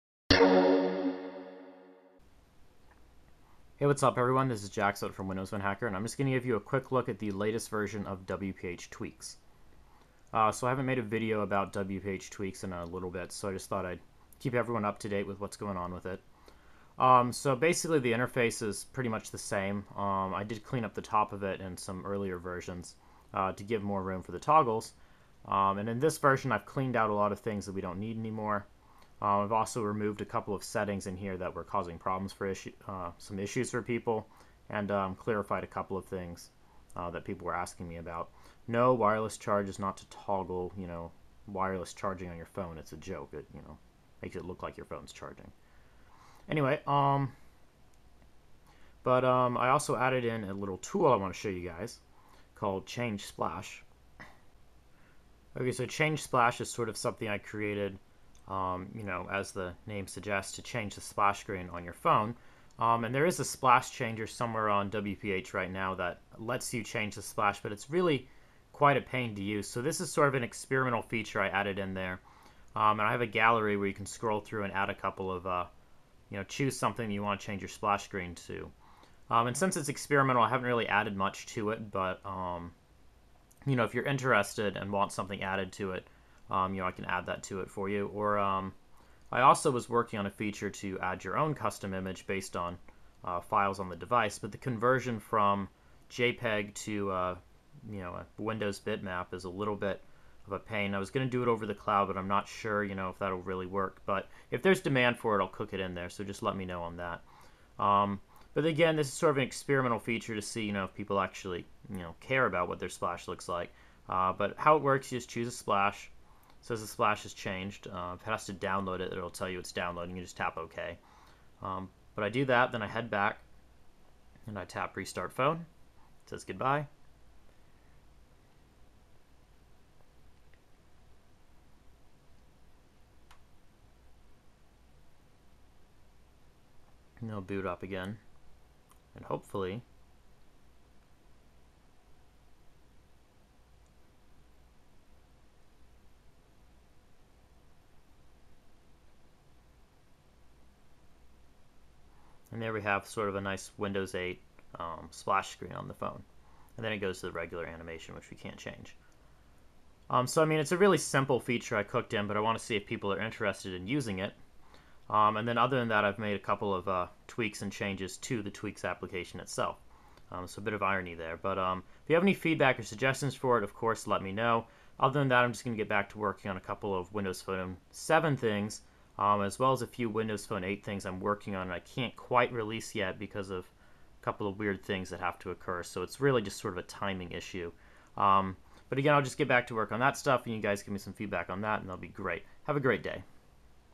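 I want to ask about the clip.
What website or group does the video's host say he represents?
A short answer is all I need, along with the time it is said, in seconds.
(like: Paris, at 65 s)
Windows Phone Hacker, at 5 s.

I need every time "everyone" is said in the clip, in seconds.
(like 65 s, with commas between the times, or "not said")
4 s, 14 s.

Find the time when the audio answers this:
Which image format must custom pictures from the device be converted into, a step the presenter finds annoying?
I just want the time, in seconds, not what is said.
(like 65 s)
98 s.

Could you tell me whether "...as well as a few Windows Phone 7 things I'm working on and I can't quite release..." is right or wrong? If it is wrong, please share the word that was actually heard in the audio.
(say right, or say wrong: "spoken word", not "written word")
wrong: "8", not "7".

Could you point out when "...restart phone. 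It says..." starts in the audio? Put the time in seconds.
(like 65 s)
124 s.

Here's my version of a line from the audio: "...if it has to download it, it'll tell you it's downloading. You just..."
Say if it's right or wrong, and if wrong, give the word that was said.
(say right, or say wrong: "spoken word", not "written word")
right.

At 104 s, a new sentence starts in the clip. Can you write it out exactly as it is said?
But if there's demand for it, I'll cook it in there.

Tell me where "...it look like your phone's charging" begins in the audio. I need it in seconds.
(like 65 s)
44 s.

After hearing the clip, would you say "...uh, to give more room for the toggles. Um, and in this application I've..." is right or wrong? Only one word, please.
wrong.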